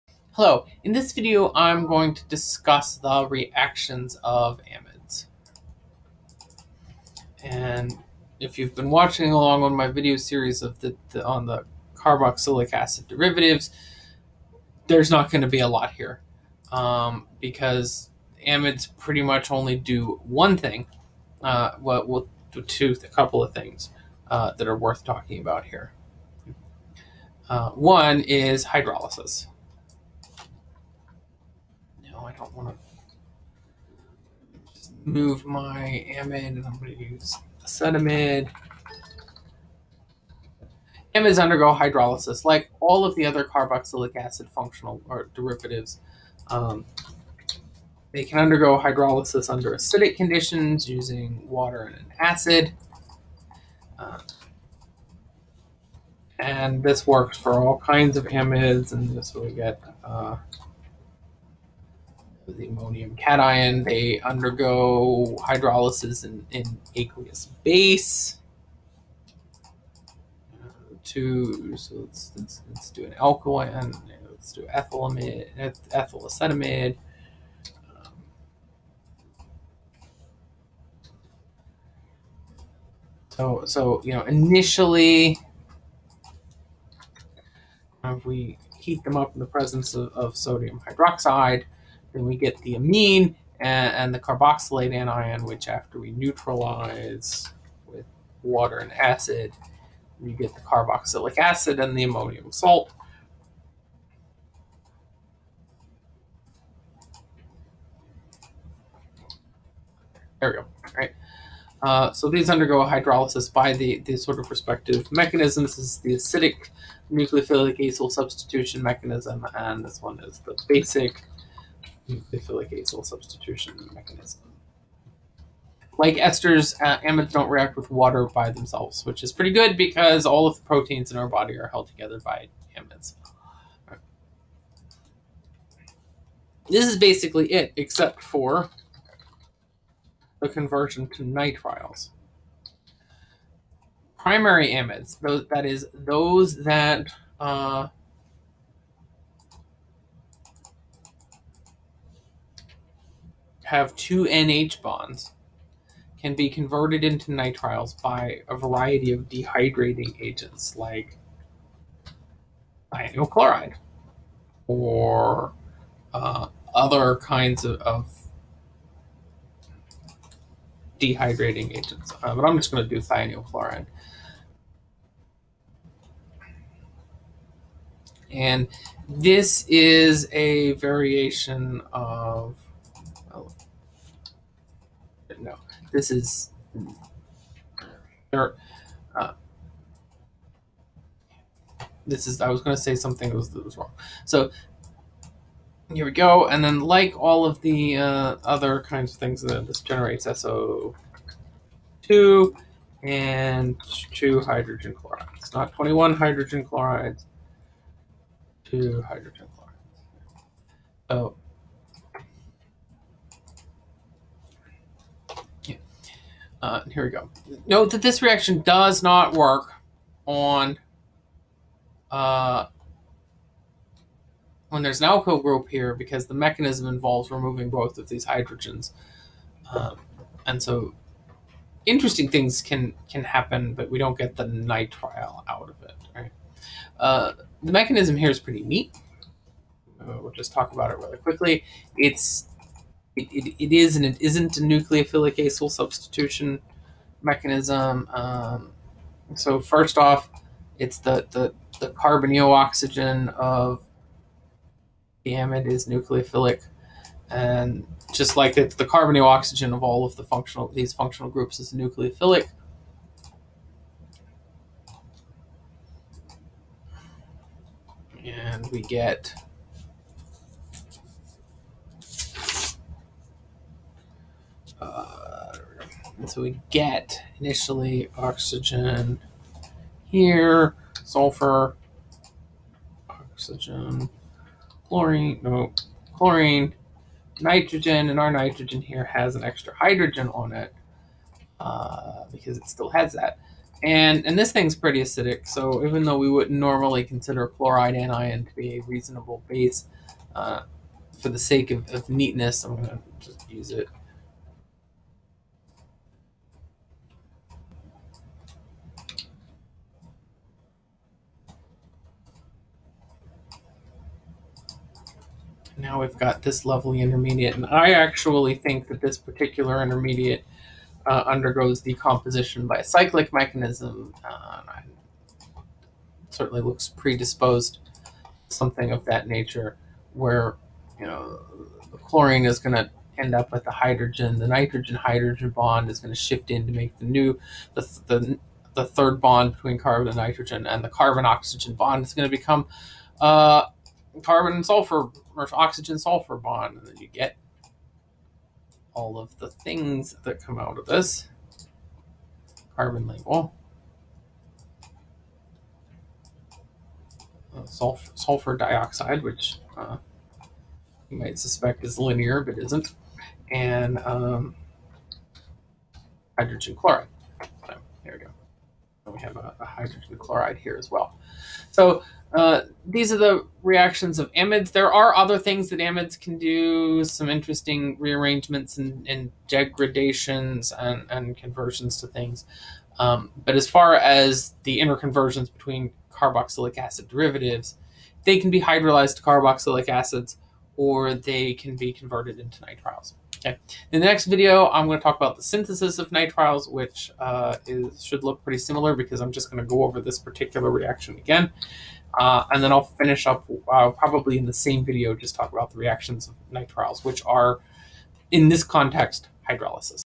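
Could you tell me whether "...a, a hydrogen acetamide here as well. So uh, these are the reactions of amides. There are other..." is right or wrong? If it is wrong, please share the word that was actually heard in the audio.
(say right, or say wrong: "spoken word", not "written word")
wrong: "chloride", not "acetamide".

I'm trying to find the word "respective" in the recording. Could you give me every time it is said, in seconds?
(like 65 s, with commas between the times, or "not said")
114 s.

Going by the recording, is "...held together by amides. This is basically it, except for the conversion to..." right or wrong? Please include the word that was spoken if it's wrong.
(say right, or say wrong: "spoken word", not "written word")
right.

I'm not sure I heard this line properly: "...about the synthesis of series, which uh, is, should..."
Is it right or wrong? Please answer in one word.
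wrong.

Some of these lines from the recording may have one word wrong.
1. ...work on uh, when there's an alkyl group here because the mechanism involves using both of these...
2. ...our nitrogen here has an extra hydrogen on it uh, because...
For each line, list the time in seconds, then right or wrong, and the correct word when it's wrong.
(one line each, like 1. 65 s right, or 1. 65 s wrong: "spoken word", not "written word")
1. 219 s wrong: "removing", not "using"
2. 288 s right.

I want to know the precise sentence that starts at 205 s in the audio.
Not 21 hydrogen chlorides, two hydrogen chlorides.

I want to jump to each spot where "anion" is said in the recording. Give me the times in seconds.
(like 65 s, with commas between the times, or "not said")
94 s, 297 s.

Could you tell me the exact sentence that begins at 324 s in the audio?
Uh, certainly looks predisposed something of that nature where, you know, the chlorine is going to end up with the hydrogen.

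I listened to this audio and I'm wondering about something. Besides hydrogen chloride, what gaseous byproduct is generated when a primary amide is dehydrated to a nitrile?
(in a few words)
SO2.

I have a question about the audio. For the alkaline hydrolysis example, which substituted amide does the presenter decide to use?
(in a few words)
ethyl acetamide.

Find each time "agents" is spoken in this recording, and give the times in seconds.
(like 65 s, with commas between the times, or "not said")
160 s, 171 s.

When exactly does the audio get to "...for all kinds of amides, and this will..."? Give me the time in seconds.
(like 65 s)
57 s.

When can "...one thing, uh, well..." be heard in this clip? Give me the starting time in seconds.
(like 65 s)
20 s.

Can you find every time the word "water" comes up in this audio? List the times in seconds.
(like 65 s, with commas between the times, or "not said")
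51 s, 98 s, 127 s.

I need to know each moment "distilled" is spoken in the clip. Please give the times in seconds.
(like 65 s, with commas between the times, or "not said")
not said.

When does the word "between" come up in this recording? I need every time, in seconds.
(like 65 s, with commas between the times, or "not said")
339 s, 385 s.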